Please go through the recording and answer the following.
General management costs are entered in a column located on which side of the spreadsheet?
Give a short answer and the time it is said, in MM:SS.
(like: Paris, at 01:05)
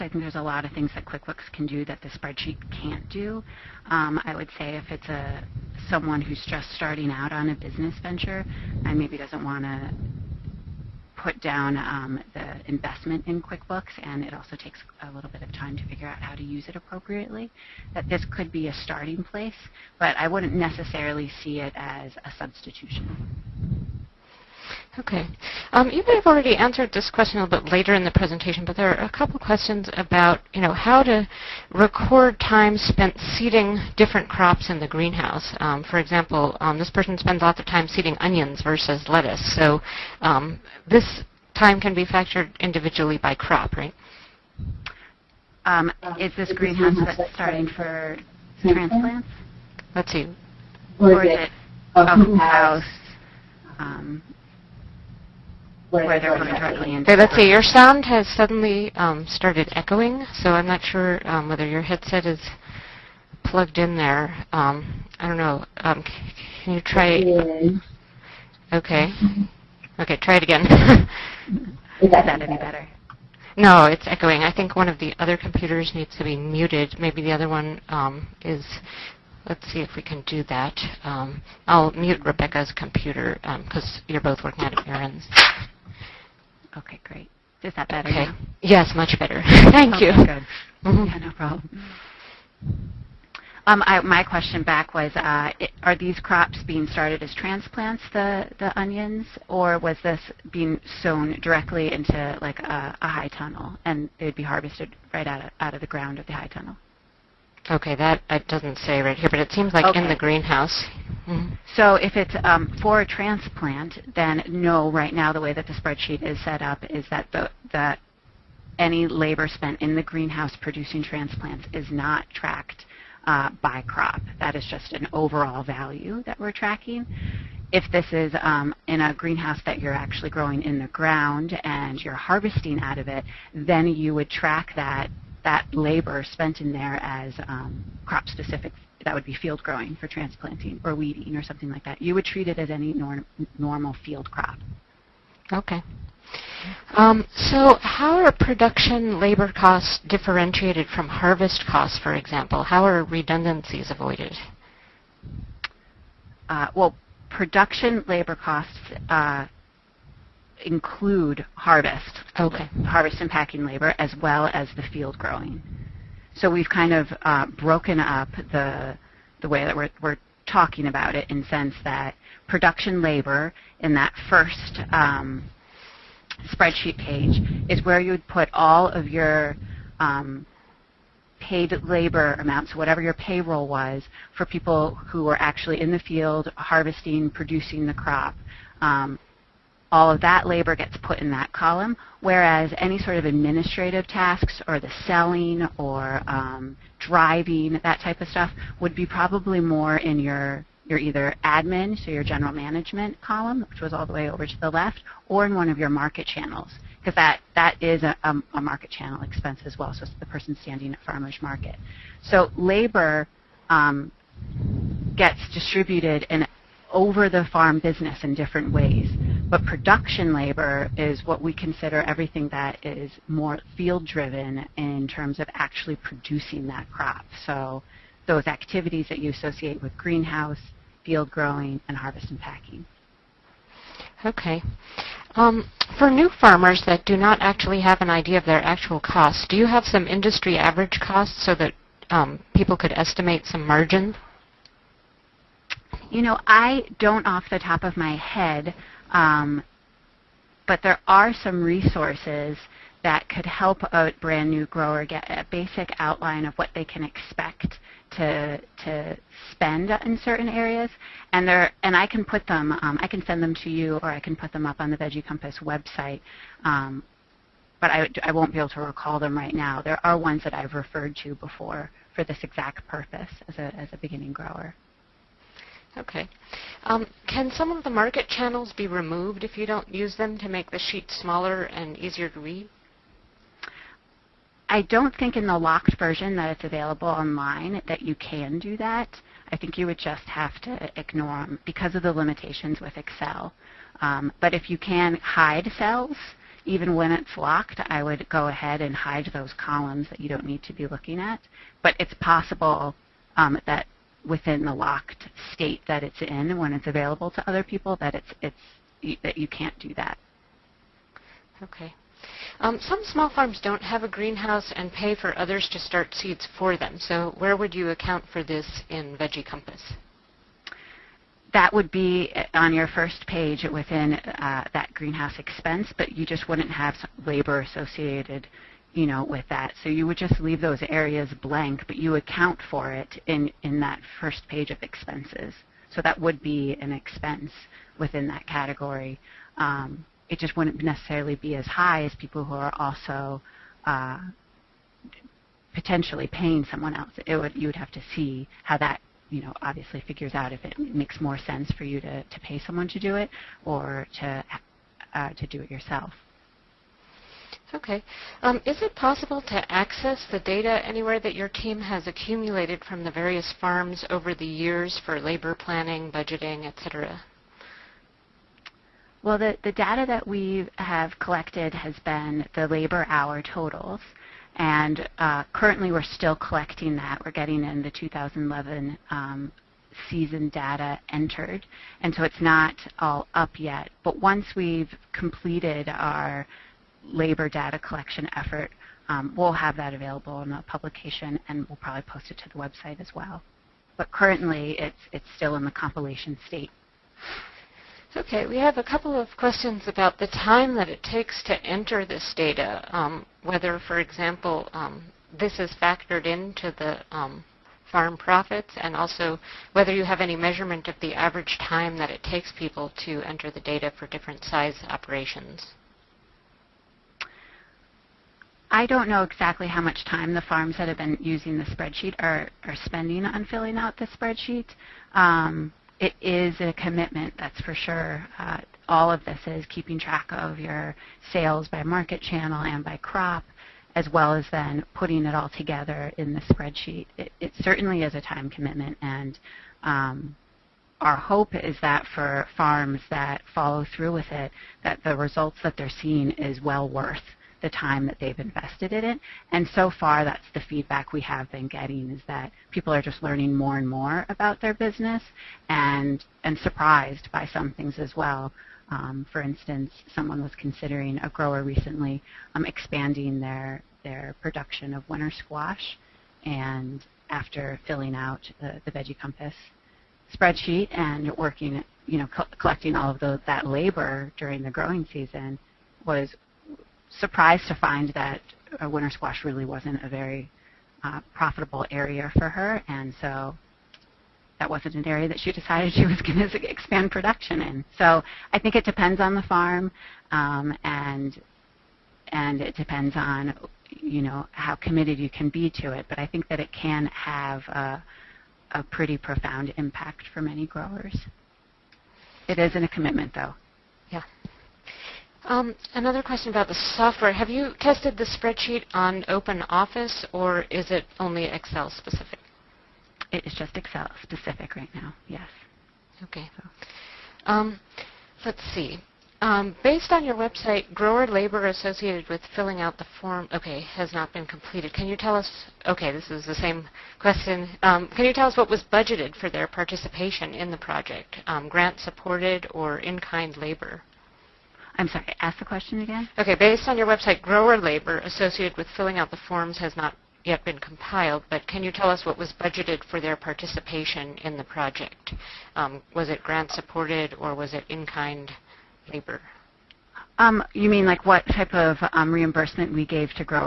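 left, at 03:24.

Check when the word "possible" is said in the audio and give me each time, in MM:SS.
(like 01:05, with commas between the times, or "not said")
05:02, 05:58.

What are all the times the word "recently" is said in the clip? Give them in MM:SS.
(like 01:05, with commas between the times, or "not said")
07:41.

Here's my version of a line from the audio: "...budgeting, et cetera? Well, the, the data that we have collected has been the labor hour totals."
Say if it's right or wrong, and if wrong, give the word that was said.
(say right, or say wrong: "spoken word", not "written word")
right.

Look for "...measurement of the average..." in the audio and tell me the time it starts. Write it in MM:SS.
06:50.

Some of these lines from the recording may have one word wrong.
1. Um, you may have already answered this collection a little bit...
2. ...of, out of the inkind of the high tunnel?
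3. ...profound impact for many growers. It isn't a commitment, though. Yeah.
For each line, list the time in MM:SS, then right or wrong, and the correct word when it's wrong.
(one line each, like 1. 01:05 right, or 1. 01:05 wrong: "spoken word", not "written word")
1. 00:25 wrong: "question", not "collection"
2. 01:45 wrong: "ground", not "inkind"
3. 08:19 right.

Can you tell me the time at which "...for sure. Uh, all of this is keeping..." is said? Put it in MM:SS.
07:07.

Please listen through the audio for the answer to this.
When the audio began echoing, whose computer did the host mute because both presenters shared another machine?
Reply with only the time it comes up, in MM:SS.
01:22.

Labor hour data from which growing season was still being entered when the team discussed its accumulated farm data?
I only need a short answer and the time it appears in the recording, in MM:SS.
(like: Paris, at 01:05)
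2011, at 06:17.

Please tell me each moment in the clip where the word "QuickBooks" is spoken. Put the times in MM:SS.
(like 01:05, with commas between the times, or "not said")
00:01, 00:13.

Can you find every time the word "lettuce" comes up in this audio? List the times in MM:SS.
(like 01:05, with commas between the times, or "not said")
00:39.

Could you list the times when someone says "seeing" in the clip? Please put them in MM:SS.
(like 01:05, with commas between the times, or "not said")
07:26.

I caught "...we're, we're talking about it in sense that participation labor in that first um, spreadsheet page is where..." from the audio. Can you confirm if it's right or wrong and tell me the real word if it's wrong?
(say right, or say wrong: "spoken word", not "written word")
wrong: "production", not "participation".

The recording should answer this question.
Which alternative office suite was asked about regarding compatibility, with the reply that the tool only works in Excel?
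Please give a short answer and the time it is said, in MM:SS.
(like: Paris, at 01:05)
OpenOffice, at 08:29.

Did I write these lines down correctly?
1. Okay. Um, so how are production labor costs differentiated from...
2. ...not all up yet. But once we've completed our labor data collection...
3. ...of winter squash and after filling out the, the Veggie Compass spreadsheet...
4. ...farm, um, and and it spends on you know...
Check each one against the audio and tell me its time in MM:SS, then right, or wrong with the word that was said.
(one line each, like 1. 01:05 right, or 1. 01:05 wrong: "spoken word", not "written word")
1. 02:25 right
2. 06:22 right
3. 07:44 right
4. 08:09 wrong: "depends", not "spends".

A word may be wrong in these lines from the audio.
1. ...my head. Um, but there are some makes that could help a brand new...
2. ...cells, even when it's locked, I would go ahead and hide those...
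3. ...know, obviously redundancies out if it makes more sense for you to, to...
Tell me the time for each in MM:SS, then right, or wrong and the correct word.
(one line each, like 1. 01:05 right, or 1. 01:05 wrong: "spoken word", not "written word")
1. 04:07 wrong: "resources", not "makes"
2. 04:55 right
3. 05:49 wrong: "figures", not "redundancies".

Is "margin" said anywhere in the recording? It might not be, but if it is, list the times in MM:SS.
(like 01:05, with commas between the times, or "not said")
04:03.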